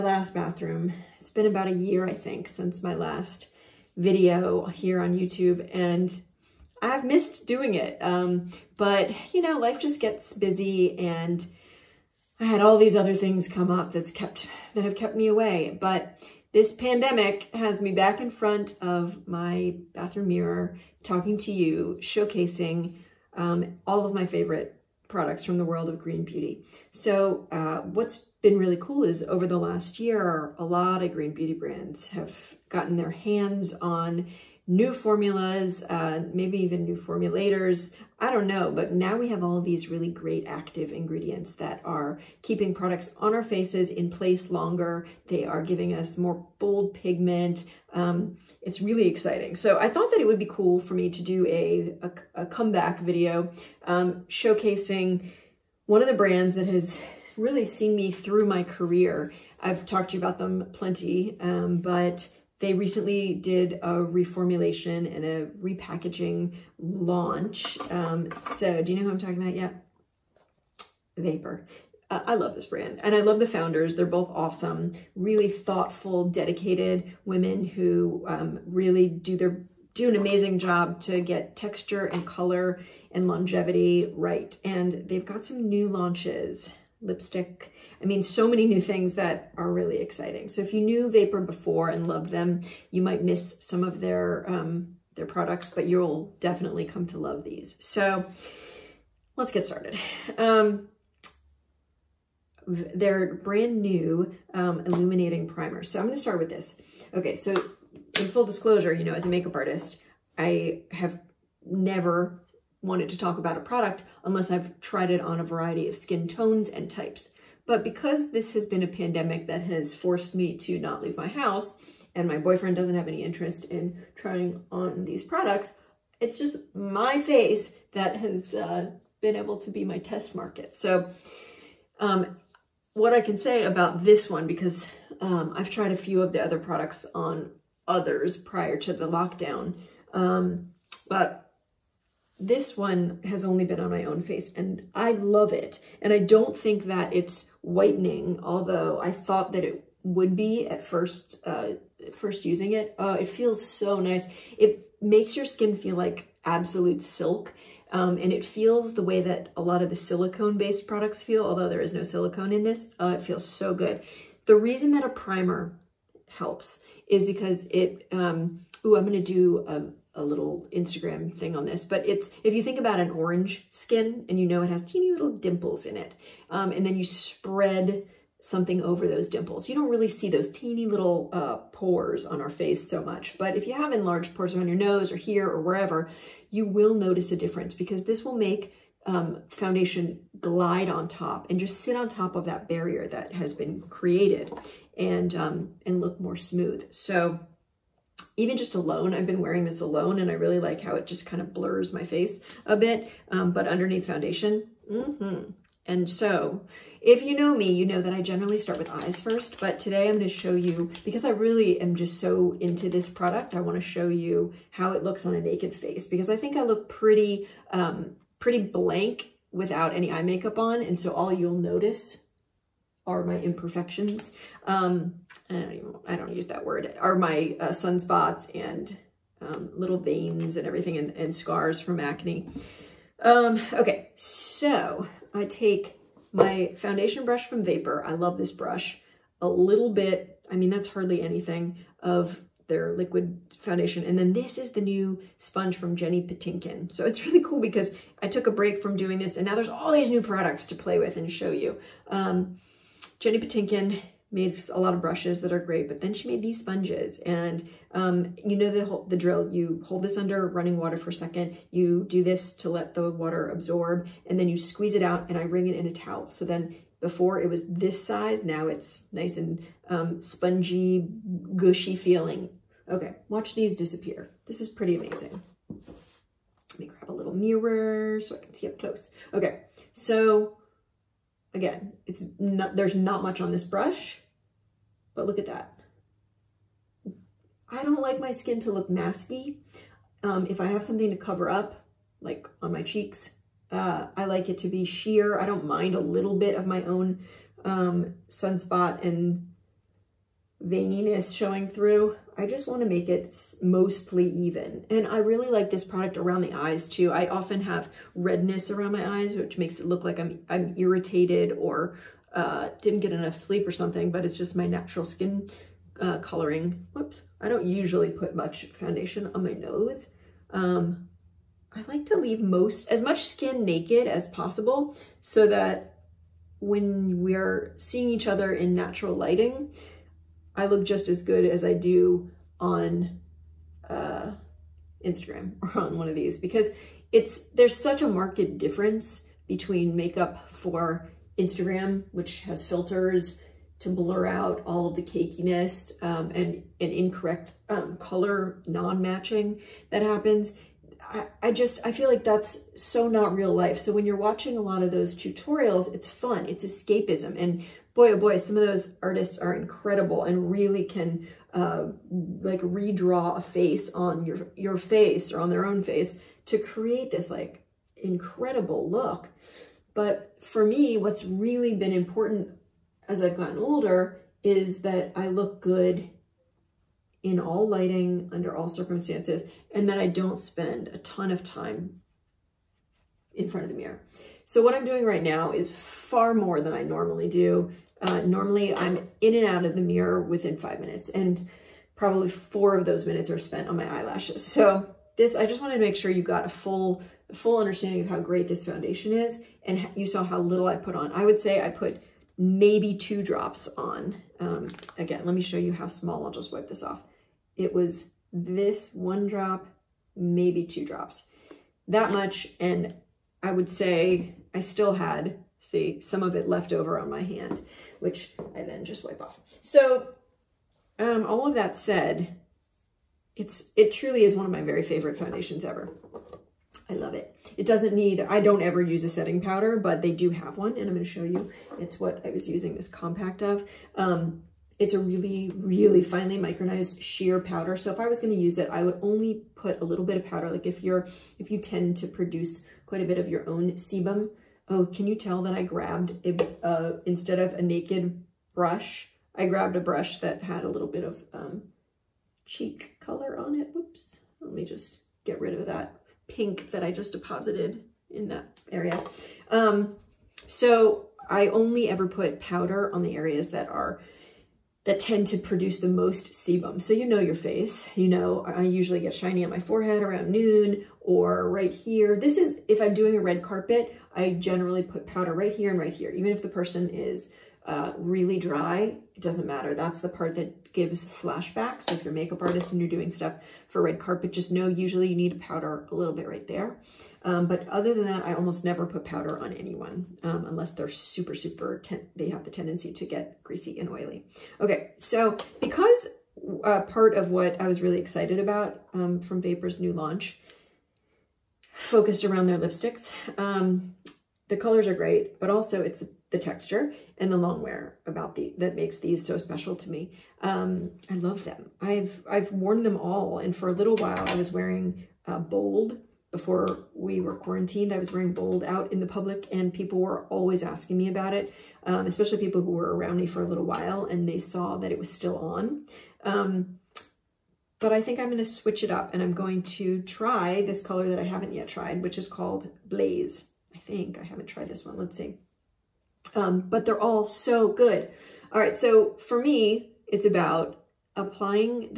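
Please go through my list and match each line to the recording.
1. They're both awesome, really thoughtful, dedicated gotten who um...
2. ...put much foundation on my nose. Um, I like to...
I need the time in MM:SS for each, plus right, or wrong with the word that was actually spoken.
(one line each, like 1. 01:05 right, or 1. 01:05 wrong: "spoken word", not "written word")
1. 01:13 wrong: "women", not "gotten"
2. 05:18 right.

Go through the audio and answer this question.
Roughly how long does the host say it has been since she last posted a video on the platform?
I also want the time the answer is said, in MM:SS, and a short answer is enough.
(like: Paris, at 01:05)
About a year, at 00:01.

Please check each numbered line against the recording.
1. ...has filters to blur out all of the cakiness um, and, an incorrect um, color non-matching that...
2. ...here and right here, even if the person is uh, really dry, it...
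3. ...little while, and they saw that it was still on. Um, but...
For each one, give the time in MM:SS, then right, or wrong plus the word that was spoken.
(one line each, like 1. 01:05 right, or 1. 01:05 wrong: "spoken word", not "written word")
1. 05:42 right
2. 07:55 right
3. 08:43 right.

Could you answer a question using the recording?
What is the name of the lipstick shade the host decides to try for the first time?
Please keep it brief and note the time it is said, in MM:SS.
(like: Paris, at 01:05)
Blaze, at 08:52.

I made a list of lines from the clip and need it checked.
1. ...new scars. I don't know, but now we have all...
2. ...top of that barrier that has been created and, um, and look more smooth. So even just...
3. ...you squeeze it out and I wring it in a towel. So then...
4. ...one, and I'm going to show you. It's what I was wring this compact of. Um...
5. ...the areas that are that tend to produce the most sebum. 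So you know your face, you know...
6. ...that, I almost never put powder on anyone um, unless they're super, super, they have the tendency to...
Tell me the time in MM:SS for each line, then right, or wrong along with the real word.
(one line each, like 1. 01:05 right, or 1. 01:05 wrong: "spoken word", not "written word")
1. 00:36 wrong: "formulators", not "scars"
2. 03:12 right
3. 04:24 right
4. 07:10 wrong: "using", not "wring"
5. 07:43 right
6. 08:08 right.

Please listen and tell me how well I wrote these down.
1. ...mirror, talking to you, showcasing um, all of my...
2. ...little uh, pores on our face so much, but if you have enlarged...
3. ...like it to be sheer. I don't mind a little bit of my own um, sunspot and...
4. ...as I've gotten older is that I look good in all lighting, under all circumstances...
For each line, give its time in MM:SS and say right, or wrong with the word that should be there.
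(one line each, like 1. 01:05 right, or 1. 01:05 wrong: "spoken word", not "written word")
1. 00:20 right
2. 03:00 right
3. 04:54 right
4. 06:13 right.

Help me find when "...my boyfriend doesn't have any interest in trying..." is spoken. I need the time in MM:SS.
02:02.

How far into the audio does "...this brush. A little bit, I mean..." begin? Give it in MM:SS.
03:58.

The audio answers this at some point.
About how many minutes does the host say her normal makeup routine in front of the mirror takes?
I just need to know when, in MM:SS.
06:30.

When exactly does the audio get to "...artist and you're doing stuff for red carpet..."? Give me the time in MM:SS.
08:02.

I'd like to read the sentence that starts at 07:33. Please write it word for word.
Whoops, let me just get rid of that pink that I just deposited in that area.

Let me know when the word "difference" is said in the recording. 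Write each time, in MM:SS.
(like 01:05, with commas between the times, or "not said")
03:07, 05:38.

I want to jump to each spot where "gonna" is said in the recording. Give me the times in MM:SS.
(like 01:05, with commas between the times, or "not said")
03:30, 07:18.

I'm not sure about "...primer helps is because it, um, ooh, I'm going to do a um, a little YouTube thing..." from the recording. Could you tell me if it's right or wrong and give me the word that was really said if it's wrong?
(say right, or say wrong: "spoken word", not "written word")
wrong: "Instagram", not "YouTube".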